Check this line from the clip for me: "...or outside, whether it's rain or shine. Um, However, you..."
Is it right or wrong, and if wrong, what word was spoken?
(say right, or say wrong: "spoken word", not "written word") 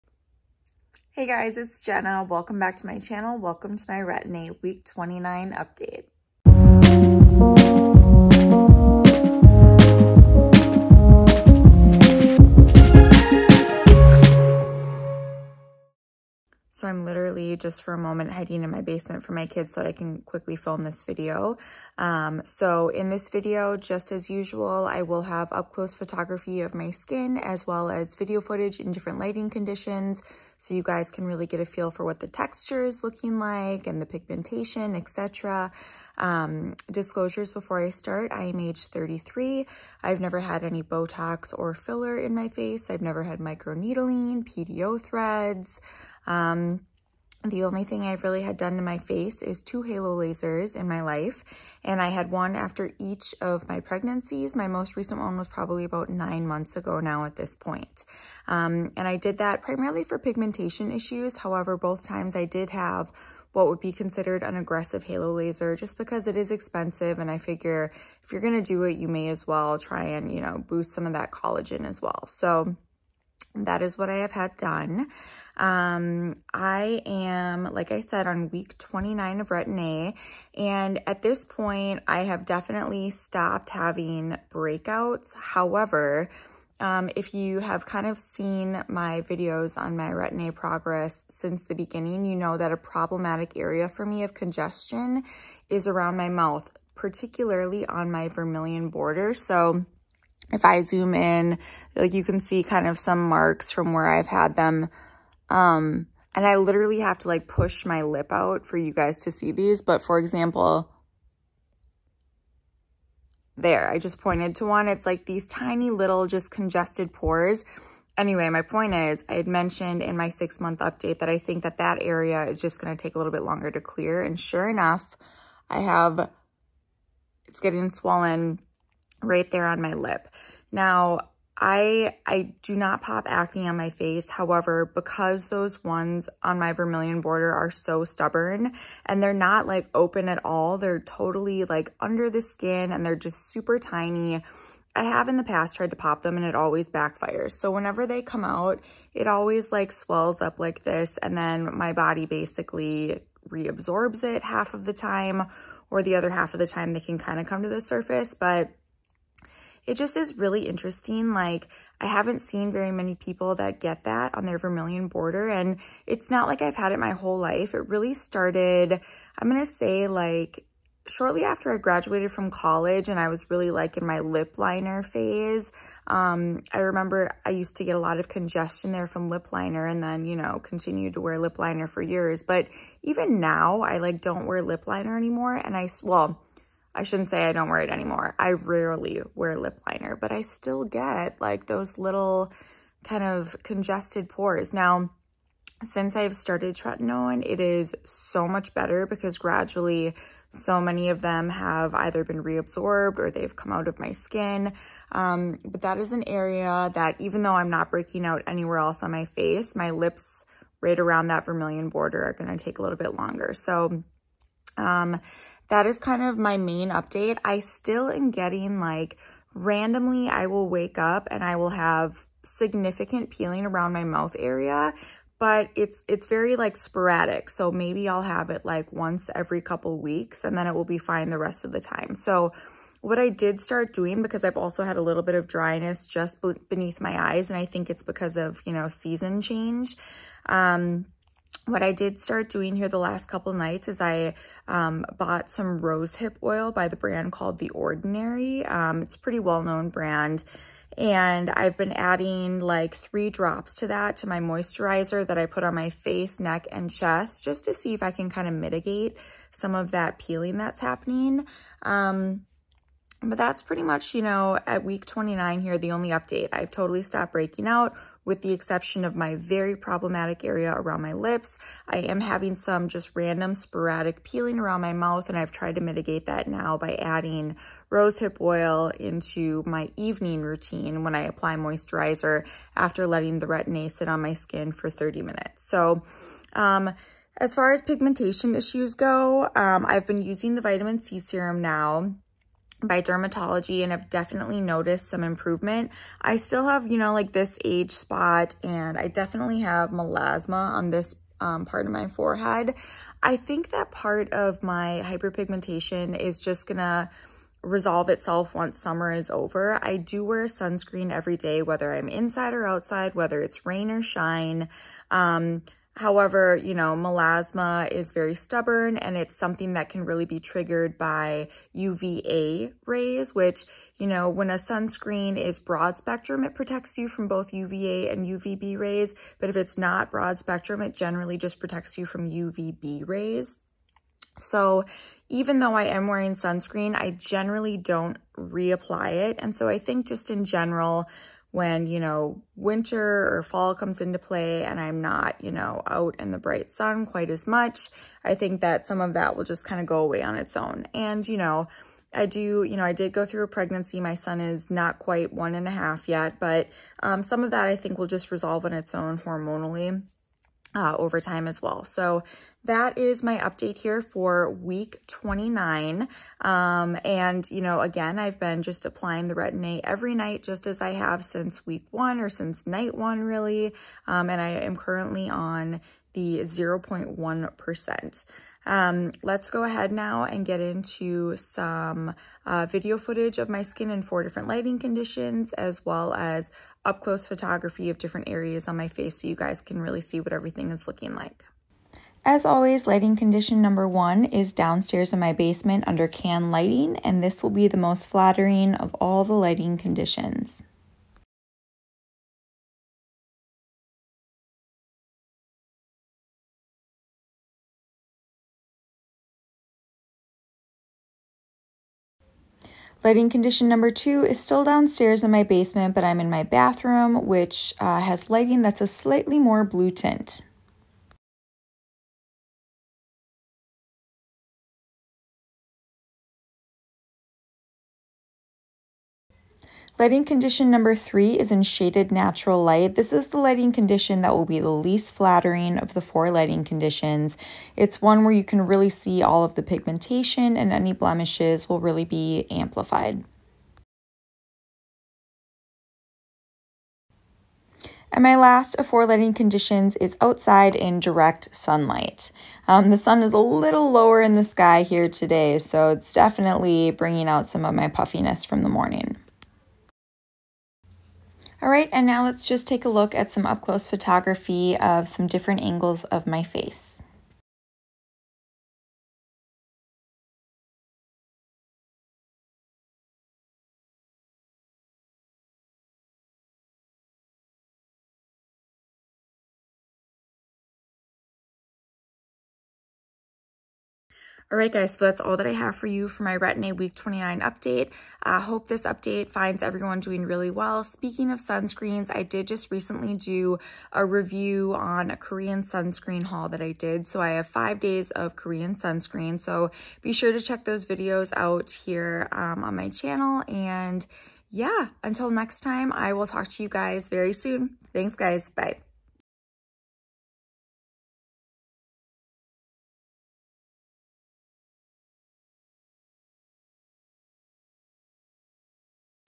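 right.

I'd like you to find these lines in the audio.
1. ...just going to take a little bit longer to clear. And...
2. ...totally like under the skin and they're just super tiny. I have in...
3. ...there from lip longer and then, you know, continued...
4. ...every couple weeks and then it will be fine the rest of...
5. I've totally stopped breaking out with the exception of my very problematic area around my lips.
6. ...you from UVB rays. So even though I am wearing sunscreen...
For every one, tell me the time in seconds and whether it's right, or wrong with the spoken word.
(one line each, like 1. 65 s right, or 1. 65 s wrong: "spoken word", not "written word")
1. 122 s right
2. 141 s right
3. 178 s wrong: "liner", not "longer"
4. 229 s right
5. 266 s right
6. 331 s right.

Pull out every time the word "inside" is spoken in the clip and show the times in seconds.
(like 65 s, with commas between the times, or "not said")
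312 s.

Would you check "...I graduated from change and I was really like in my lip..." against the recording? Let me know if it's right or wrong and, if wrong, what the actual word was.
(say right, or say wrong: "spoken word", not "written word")
wrong: "college", not "change".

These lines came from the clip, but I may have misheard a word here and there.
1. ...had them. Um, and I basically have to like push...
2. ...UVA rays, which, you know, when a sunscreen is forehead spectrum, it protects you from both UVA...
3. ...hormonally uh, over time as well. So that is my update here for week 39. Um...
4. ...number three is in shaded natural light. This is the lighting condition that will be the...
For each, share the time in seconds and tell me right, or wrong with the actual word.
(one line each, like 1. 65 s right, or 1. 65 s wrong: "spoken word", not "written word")
1. 104 s wrong: "literally", not "basically"
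2. 321 s wrong: "broad", not "forehead"
3. 359 s wrong: "29", not "39"
4. 430 s right.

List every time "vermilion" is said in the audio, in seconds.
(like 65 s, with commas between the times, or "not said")
98 s, 136 s, 164 s, 211 s.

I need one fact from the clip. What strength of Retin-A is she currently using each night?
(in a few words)
0.1%.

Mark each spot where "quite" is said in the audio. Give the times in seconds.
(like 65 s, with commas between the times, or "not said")
347 s, 354 s.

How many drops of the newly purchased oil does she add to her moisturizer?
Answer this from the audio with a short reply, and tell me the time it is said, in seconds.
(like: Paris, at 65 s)
3, at 252 s.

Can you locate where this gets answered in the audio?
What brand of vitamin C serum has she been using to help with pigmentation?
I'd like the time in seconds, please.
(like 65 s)
293 s.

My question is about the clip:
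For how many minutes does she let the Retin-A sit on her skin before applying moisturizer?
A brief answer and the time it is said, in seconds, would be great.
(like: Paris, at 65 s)
30, at 284 s.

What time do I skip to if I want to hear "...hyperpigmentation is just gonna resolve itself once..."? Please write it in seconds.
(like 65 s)
305 s.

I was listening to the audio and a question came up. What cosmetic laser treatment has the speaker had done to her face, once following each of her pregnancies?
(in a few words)
halo laser.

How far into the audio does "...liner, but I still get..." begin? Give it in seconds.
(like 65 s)
189 s.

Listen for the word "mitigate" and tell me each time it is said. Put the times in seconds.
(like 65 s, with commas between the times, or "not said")
258 s, 275 s.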